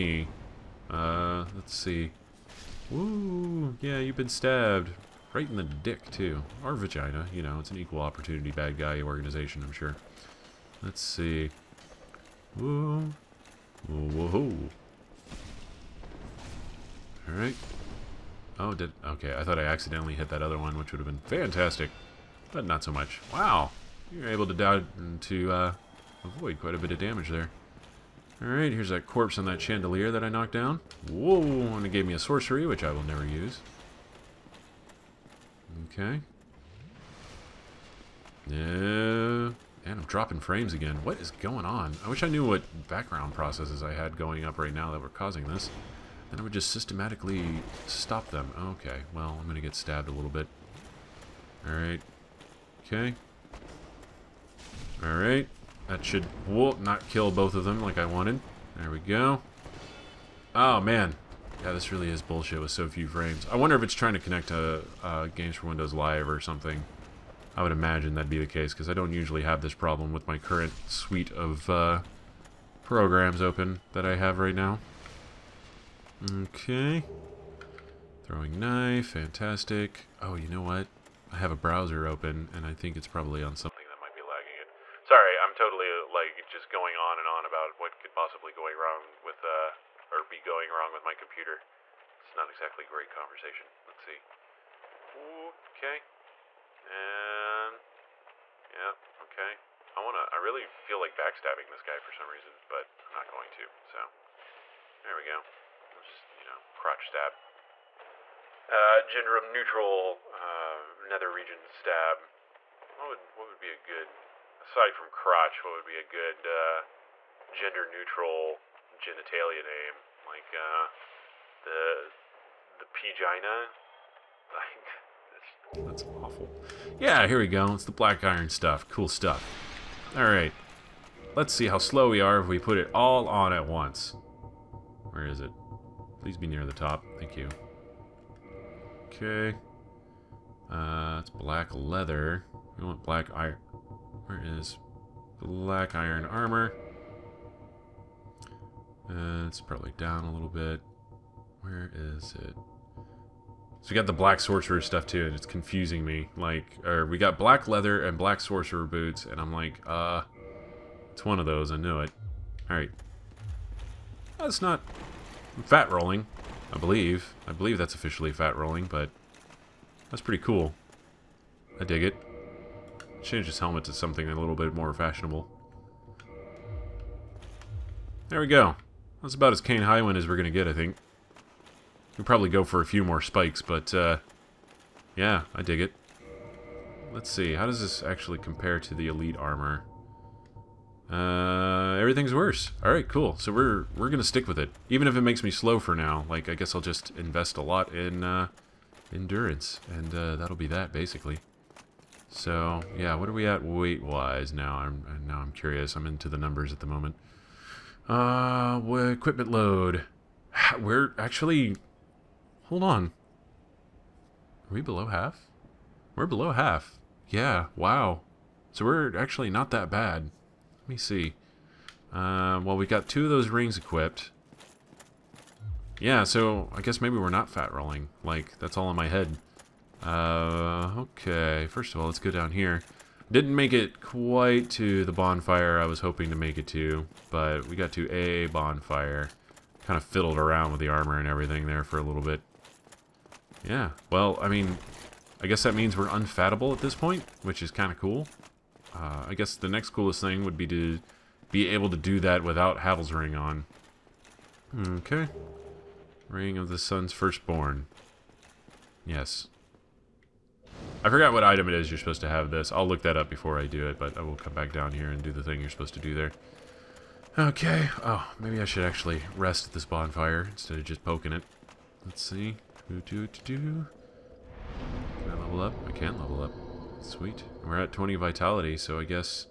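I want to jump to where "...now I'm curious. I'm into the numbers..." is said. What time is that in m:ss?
3:25.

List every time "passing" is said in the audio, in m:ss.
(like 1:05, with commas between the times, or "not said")
not said.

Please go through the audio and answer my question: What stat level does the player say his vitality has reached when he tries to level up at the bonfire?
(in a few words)
20.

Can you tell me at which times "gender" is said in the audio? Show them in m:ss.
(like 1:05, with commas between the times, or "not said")
1:49, 1:57.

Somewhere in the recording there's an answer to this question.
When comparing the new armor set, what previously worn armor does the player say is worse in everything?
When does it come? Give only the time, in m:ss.
3:09.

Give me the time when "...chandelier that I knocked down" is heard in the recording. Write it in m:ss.
0:29.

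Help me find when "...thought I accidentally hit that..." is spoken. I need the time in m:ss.
0:19.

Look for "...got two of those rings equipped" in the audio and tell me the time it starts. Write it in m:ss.
3:42.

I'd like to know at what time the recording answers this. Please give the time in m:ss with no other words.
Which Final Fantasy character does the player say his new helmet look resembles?
2:59.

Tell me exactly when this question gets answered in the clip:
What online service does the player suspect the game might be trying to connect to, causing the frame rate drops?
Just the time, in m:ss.
1:05.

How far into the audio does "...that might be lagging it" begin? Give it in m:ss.
1:23.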